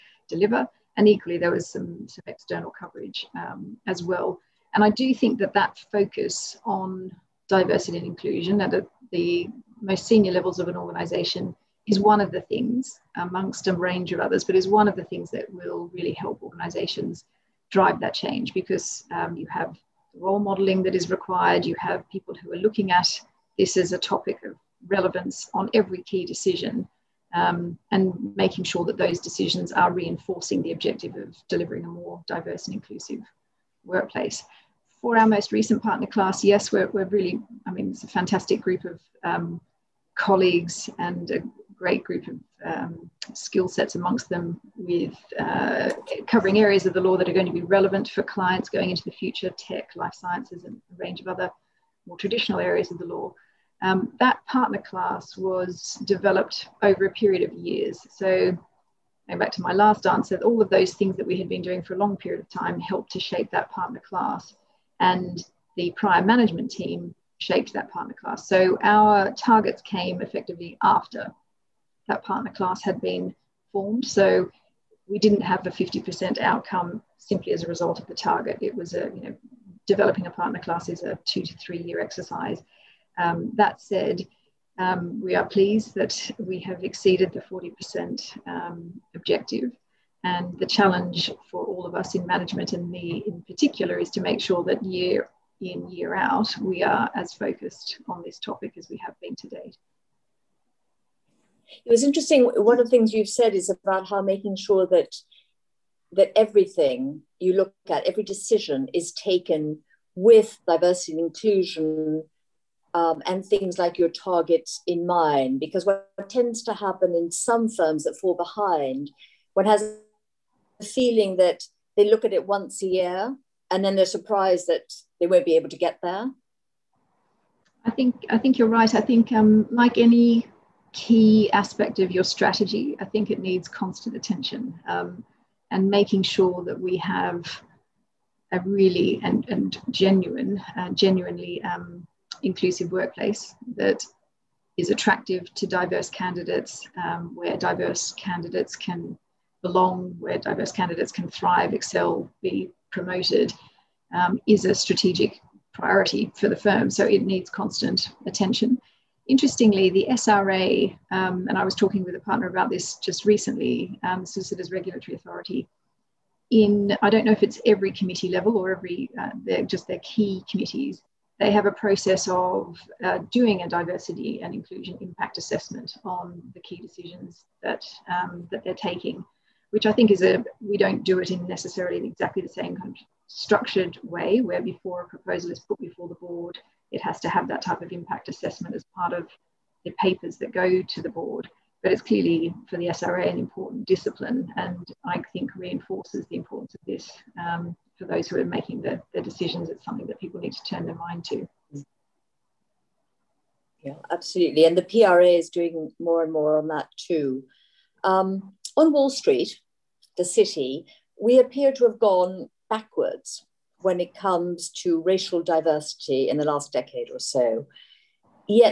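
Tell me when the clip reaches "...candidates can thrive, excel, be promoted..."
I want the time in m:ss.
2:30.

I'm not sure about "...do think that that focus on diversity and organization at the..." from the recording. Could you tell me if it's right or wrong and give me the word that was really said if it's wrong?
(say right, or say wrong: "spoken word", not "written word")
wrong: "inclusion", not "organization".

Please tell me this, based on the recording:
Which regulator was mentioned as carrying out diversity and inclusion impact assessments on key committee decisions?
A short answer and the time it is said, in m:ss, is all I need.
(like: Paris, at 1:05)
Solicitors Regulatory Authority, at 2:44.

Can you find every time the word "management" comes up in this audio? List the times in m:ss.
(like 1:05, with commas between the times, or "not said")
1:06, 1:32.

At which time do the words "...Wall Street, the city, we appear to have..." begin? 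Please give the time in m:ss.
3:28.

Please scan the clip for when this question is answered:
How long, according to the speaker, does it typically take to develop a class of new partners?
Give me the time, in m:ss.
1:21.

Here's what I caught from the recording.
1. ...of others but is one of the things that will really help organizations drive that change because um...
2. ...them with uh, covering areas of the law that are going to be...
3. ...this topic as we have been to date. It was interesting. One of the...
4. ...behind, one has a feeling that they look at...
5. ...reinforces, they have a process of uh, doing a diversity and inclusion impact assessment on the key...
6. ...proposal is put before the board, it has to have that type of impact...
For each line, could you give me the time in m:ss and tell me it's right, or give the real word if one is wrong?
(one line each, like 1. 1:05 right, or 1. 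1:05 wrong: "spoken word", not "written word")
1. 0:14 right
2. 0:44 right
3. 1:38 right
4. 1:58 right
5. 2:50 wrong: "committees", not "reinforces"
6. 3:05 right.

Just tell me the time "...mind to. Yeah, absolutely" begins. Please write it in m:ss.
3:20.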